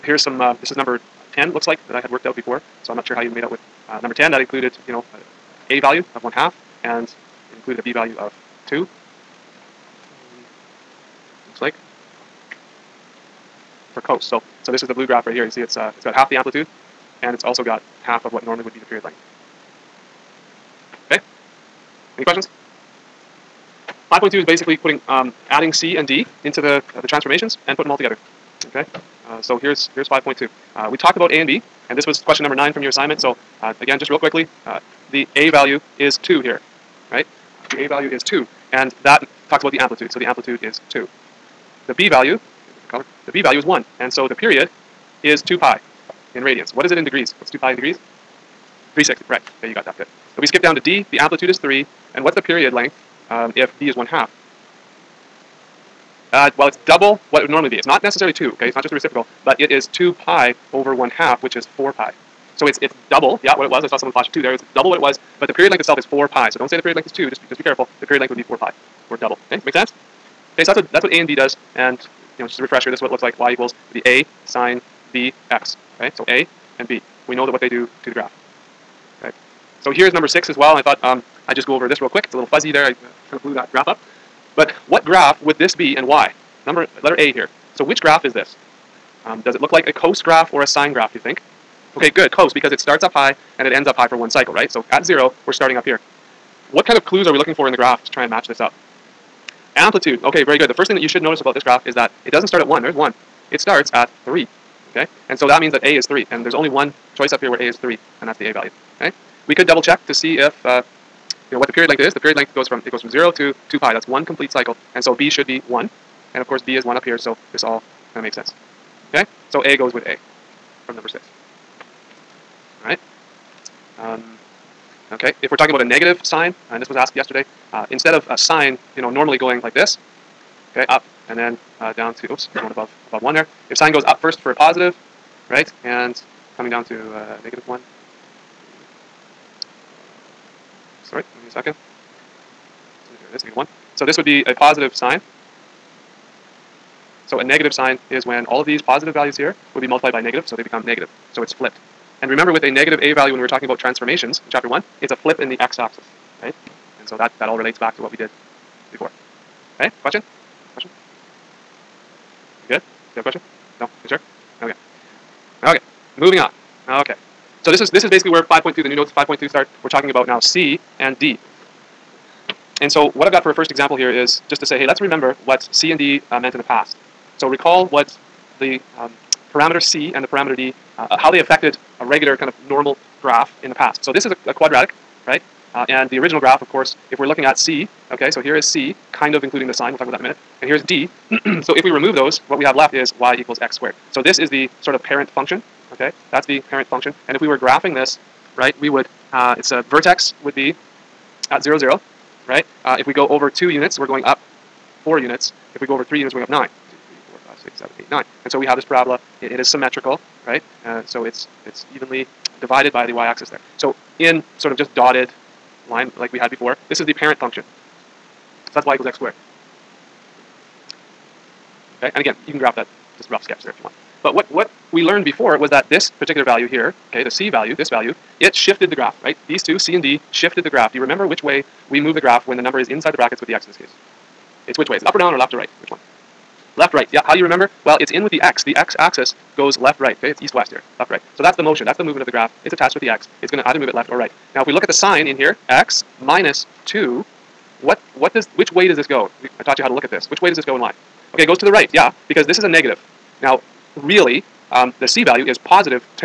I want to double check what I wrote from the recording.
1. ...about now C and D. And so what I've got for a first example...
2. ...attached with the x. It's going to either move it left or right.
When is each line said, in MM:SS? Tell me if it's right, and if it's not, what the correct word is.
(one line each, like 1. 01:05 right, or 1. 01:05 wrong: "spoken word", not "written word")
1. 02:50 right
2. 04:02 right.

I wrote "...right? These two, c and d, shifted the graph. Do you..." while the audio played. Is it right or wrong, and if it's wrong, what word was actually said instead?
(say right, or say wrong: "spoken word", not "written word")
right.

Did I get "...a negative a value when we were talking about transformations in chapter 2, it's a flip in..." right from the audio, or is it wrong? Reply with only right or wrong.
wrong.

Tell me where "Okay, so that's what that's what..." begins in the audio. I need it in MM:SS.
01:10.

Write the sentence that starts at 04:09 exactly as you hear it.
I taught you how to look at this.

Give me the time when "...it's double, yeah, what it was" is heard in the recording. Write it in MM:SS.
01:02.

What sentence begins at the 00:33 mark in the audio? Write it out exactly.
So uh, again, just real quickly, uh, the A value is 2 here, right?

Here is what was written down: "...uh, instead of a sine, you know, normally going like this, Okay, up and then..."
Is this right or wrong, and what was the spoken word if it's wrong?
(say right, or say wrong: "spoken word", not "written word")
right.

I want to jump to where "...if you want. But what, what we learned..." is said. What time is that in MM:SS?
03:43.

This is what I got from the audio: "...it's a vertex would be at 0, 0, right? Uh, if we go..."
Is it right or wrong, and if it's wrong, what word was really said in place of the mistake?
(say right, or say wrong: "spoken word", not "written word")
right.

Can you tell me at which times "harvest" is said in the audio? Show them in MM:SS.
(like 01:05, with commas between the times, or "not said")
not said.